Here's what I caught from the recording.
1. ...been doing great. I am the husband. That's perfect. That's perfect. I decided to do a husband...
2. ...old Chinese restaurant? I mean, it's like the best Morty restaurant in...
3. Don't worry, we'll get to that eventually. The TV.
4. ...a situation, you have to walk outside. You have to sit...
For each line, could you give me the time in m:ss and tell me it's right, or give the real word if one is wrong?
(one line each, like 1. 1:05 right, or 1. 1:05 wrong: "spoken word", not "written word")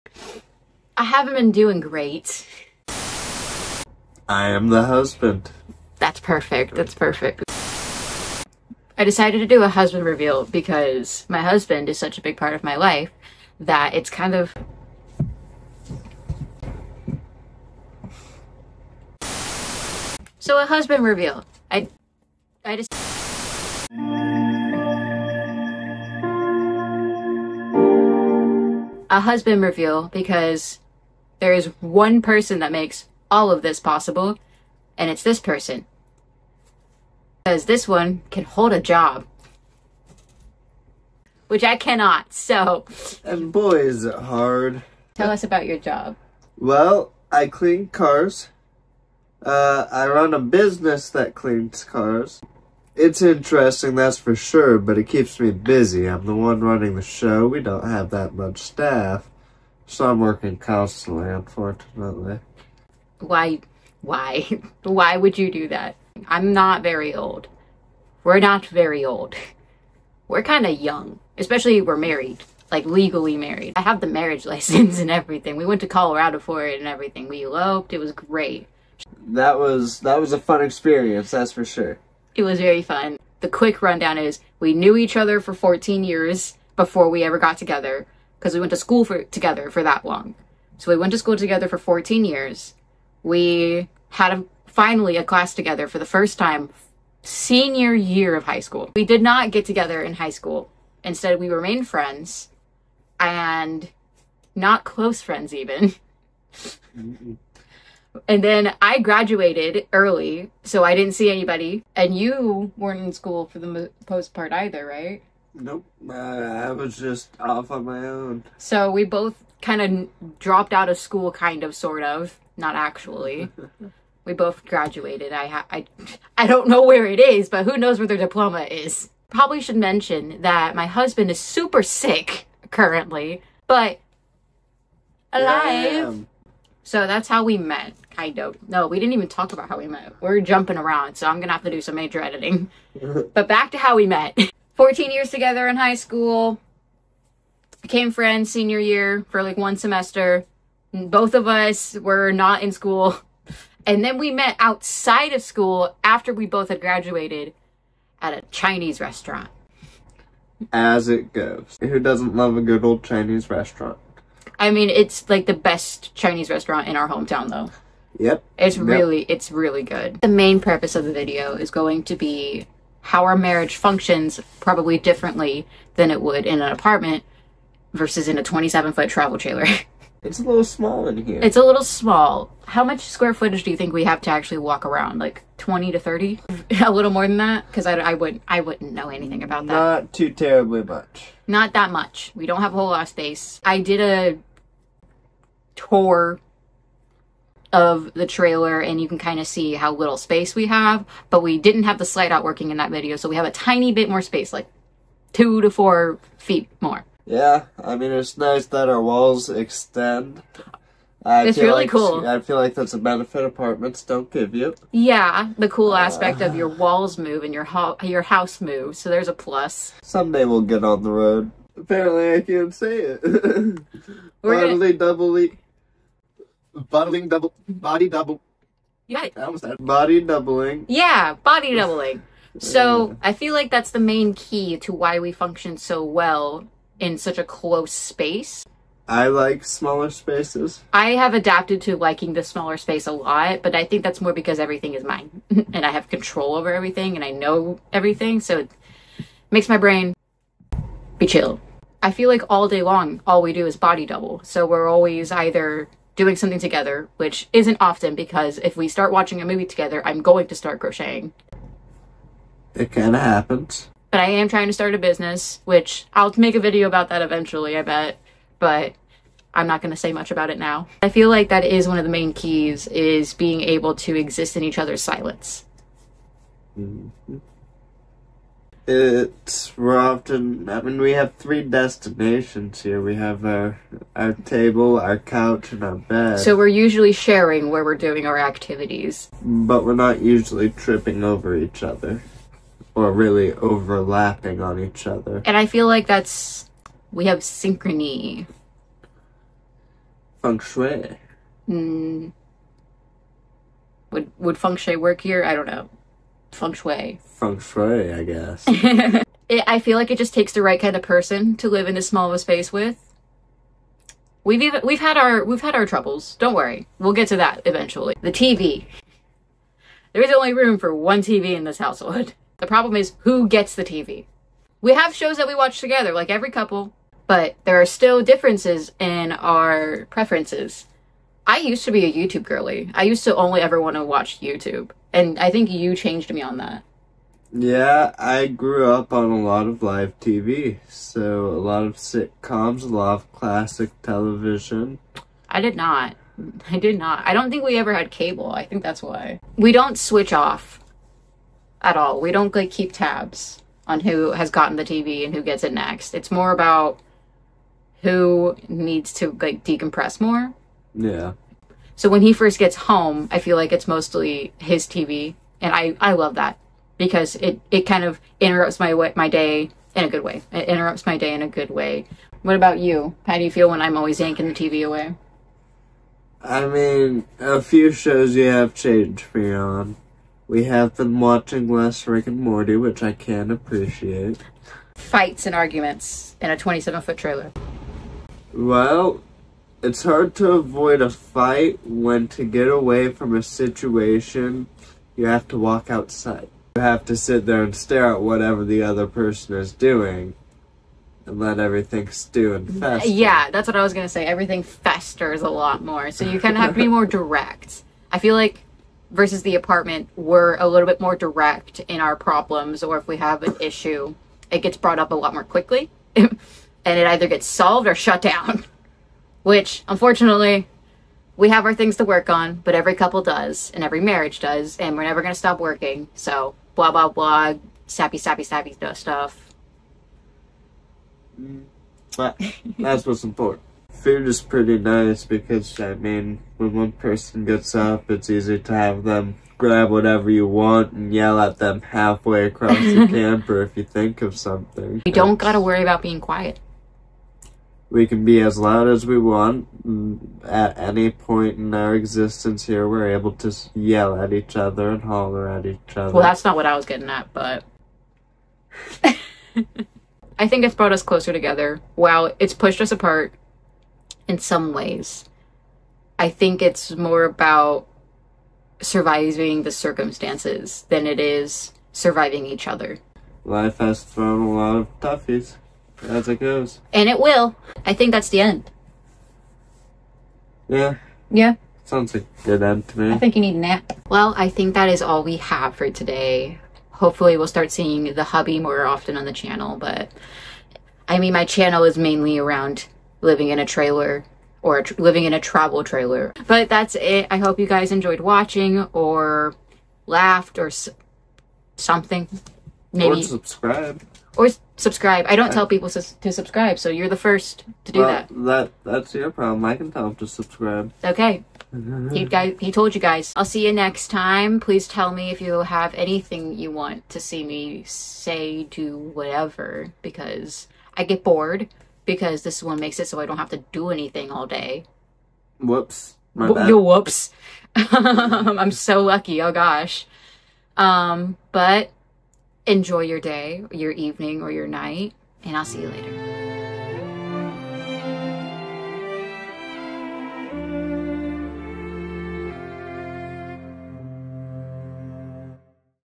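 1. 0:01 right
2. 2:42 wrong: "Chinese", not "Morty"
3. 5:16 right
4. 6:33 right.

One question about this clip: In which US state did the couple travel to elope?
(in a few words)
Colorado.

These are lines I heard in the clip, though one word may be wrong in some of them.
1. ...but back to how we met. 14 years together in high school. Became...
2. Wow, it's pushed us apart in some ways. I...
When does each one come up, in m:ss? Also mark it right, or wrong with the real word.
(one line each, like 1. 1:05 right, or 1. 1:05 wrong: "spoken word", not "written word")
1. 2:23 right
2. 7:41 right.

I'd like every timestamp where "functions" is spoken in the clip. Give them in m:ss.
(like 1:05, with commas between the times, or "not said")
2:53, 3:55.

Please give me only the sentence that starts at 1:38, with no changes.
We did not get together in high school.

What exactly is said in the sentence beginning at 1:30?
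So we went to school together for 14 years.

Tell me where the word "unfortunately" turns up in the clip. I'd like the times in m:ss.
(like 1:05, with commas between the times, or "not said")
1:01, 6:59.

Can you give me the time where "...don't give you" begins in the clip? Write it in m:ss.
3:34.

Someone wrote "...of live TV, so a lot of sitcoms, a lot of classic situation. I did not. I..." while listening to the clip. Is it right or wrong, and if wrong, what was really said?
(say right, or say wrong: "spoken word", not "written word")
wrong: "television", not "situation".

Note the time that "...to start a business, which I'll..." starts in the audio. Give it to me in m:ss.
4:24.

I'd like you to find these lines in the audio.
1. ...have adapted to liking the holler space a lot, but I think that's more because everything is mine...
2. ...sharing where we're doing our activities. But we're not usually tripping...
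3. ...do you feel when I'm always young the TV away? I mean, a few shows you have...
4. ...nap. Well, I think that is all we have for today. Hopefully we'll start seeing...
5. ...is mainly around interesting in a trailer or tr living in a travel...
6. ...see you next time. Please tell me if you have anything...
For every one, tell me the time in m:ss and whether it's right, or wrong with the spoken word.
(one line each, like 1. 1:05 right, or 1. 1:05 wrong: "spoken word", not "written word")
1. 4:01 wrong: "smaller", not "holler"
2. 4:47 right
3. 6:13 wrong: "yanking", not "young"
4. 8:03 right
5. 8:11 wrong: "living", not "interesting"
6. 8:33 right.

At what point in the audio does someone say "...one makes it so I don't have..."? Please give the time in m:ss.
8:42.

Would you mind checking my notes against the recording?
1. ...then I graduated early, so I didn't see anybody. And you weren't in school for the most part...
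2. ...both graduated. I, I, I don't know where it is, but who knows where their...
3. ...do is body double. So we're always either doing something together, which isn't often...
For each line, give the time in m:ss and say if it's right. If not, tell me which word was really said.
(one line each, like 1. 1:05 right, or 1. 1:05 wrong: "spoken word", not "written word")
1. 1:48 right
2. 2:04 right
3. 4:13 right.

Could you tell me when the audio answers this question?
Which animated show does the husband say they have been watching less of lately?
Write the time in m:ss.
6:22.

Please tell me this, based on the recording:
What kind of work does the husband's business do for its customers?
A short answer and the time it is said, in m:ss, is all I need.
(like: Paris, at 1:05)
Cleans cars, at 0:47.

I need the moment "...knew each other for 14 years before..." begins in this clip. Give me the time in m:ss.
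1:24.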